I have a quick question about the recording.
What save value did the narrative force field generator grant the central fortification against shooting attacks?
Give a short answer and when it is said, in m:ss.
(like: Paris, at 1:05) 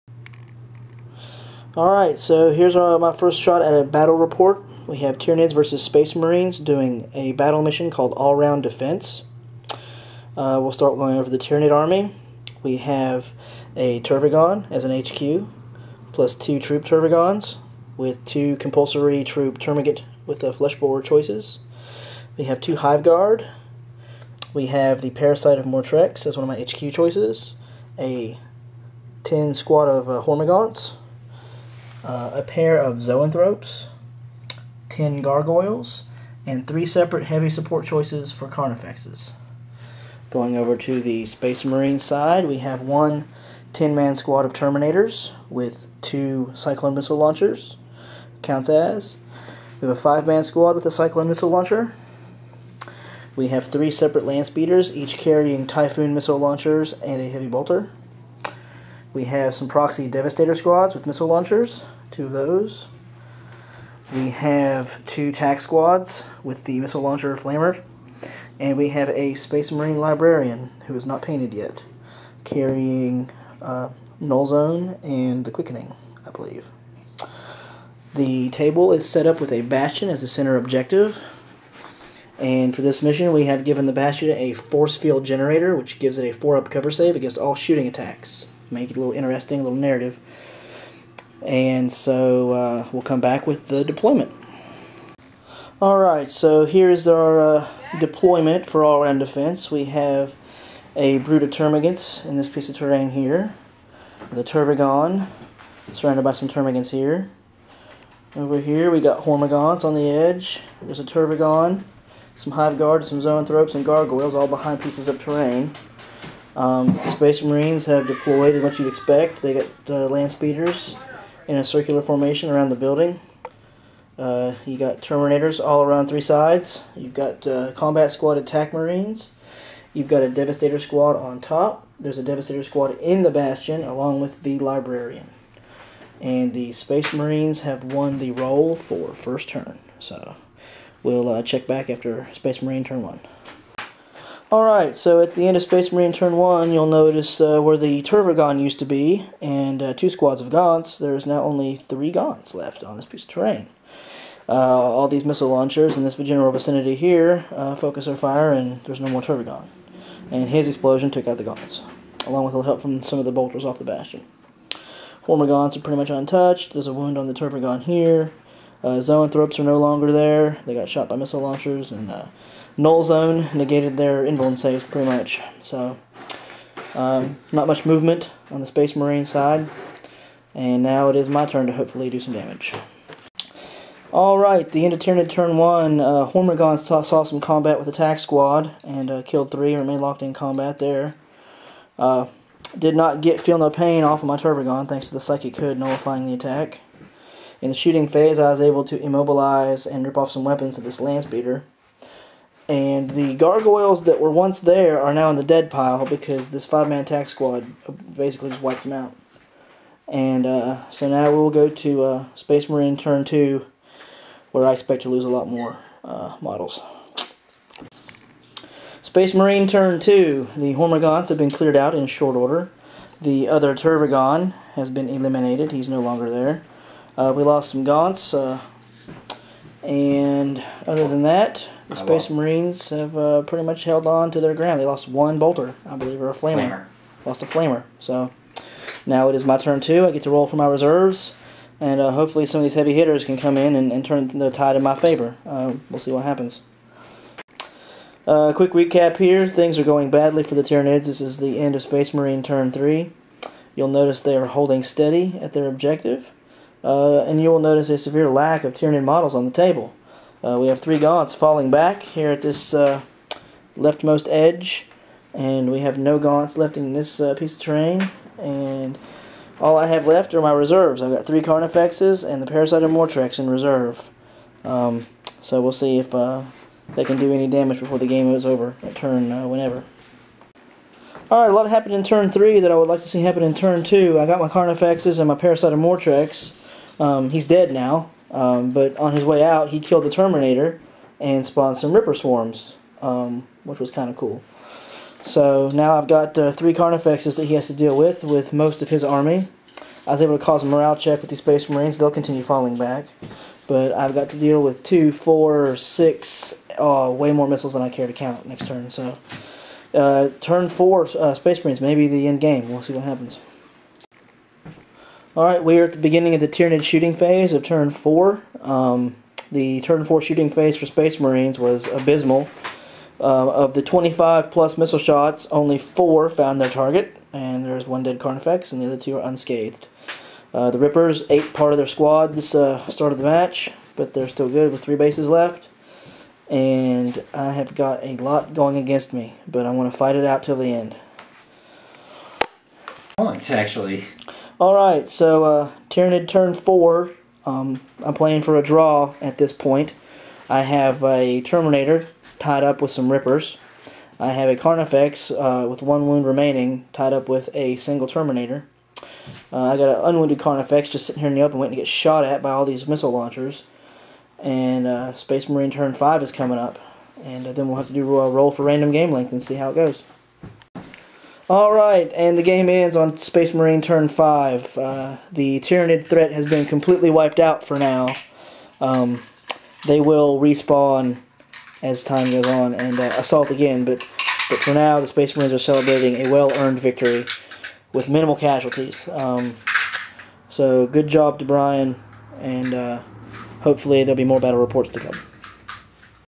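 4 up cover save, at 1:26.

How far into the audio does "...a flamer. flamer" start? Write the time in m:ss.
3:56.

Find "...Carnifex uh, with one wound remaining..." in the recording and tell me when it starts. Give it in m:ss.
5:54.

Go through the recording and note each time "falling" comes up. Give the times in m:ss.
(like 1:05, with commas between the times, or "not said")
4:21, 5:02.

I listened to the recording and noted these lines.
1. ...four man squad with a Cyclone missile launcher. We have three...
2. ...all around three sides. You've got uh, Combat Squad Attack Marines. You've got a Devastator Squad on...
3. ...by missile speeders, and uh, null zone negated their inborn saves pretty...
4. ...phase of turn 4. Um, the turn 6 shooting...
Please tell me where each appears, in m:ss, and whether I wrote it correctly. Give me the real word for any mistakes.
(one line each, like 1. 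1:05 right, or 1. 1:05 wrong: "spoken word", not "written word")
1. 0:49 wrong: "five", not "four"
2. 2:05 right
3. 2:51 wrong: "launchers", not "speeders"
4. 5:17 wrong: "4", not "6".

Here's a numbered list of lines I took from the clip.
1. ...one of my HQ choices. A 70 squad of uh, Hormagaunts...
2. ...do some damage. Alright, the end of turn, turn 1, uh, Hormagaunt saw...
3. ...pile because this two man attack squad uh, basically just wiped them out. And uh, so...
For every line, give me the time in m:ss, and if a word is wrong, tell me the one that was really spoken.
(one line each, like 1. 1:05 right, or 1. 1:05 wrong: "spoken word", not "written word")
1. 0:26 wrong: "10", not "70"
2. 3:02 right
3. 3:25 wrong: "five", not "two".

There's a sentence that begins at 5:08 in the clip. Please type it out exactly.
So uh, turn four, uh, Space Marines, maybe the end game.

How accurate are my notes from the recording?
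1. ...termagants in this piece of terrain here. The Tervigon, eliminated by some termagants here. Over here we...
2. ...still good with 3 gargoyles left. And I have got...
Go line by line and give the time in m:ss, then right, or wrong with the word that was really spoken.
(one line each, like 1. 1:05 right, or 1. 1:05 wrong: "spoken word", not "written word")
1. 1:41 wrong: "surrounded", not "eliminated"
2. 5:34 wrong: "bases", not "gargoyles".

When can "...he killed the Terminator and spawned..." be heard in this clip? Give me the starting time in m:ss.
4:49.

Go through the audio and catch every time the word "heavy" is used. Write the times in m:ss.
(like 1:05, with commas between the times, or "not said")
0:37, 0:57, 4:02.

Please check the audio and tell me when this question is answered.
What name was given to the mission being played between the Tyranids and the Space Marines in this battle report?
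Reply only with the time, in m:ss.
0:08.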